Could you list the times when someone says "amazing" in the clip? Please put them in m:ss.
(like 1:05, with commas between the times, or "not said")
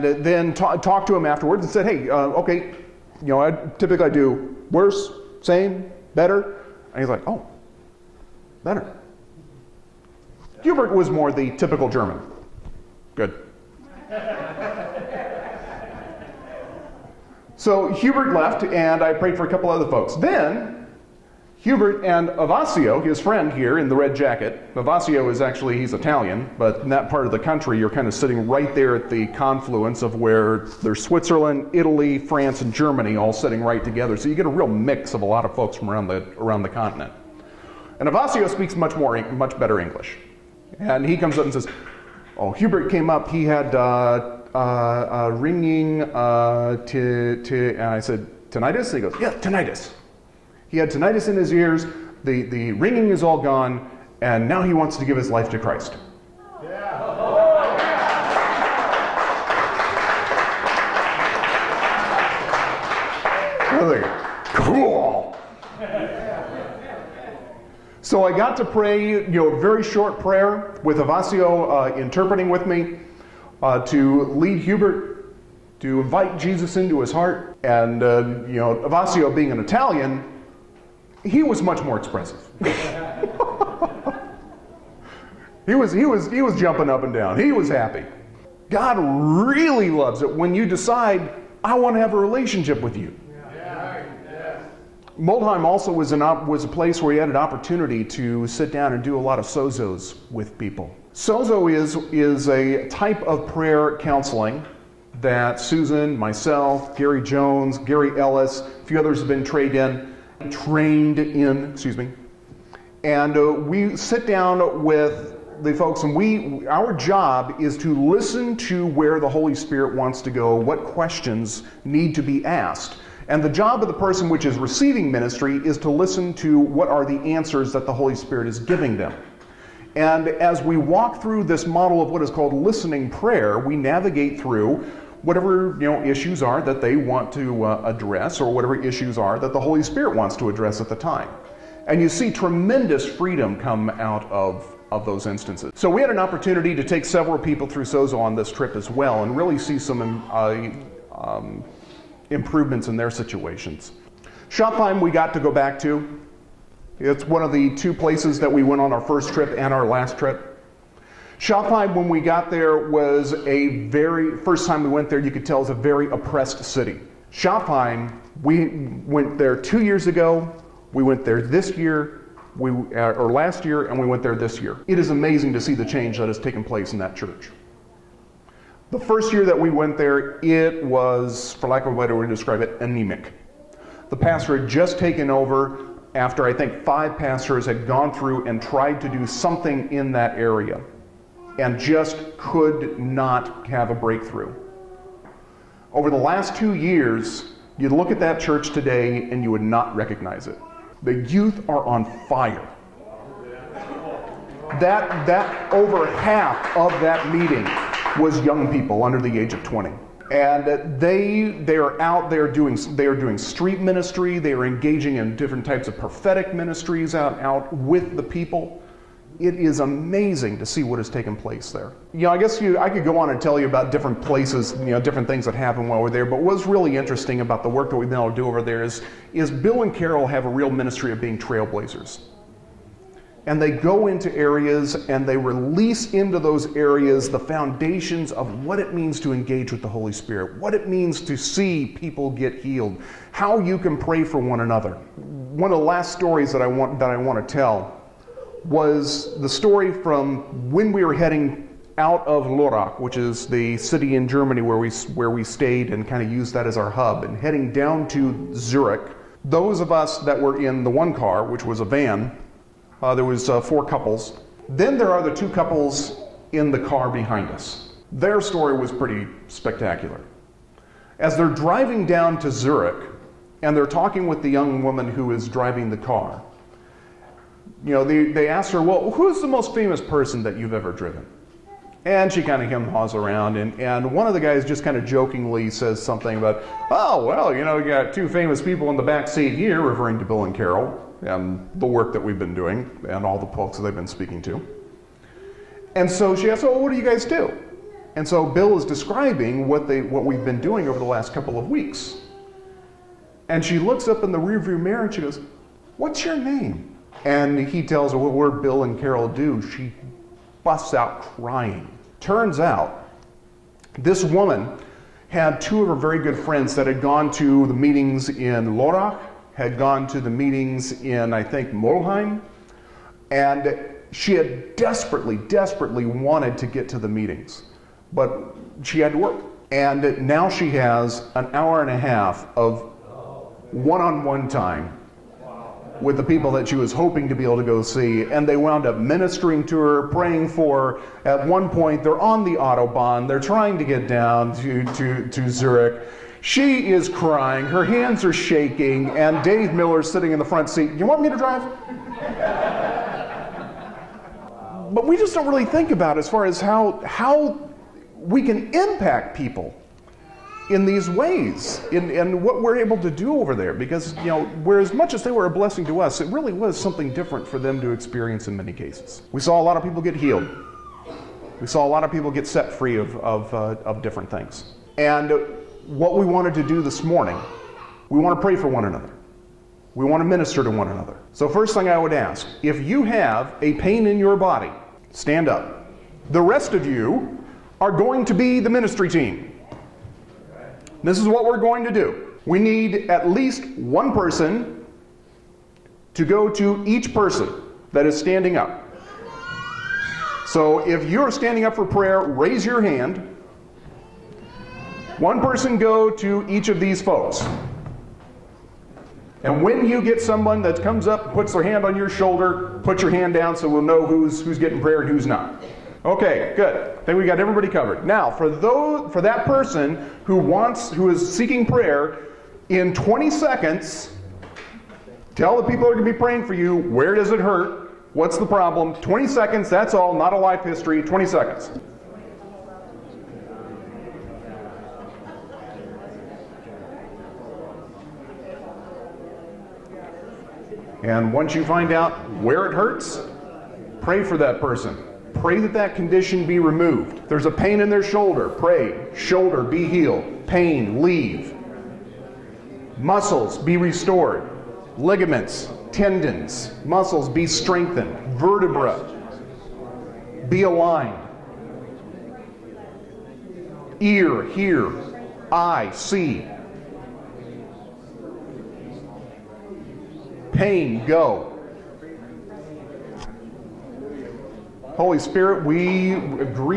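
2:55, 3:39.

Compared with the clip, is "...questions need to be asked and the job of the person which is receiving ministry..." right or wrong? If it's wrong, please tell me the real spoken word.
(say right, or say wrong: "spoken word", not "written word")
right.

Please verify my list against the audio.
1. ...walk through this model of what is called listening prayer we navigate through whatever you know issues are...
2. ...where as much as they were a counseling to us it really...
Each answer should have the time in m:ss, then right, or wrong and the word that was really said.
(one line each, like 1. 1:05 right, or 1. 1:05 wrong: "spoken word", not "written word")
1. 2:10 right
2. 6:04 wrong: "blessing", not "counseling".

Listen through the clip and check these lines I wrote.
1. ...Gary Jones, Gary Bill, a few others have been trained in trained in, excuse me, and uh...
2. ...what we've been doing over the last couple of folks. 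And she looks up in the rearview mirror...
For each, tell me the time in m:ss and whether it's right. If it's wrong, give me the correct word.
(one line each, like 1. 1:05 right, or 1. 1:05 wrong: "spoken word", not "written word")
1. 1:46 wrong: "Ellis", not "Bill"
2. 5:00 wrong: "weeks", not "folks".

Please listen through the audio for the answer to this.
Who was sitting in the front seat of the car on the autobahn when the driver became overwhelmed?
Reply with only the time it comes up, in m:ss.
5:49.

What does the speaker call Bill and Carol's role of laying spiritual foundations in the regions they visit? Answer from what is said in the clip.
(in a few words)
Trailblazers.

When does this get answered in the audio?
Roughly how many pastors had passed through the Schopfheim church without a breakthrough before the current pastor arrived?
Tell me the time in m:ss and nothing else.
3:06.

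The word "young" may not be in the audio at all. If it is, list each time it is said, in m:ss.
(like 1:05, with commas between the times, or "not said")
3:28, 4:34.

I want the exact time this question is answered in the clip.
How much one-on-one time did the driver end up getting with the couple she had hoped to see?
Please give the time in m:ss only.
5:31.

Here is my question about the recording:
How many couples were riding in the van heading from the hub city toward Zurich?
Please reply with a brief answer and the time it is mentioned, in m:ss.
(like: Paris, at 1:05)
4, at 4:23.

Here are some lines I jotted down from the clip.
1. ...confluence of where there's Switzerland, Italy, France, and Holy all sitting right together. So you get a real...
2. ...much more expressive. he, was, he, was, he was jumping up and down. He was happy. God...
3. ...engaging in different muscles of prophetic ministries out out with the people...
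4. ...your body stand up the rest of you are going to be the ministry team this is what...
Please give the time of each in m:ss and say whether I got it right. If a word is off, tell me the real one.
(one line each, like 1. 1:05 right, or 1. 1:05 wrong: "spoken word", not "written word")
1. 0:29 wrong: "Germany", not "Holy"
2. 1:21 right
3. 3:34 wrong: "types", not "muscles"
4. 6:24 right.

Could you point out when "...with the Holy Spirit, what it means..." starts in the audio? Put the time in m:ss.
3:59.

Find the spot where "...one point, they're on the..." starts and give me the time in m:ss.
5:41.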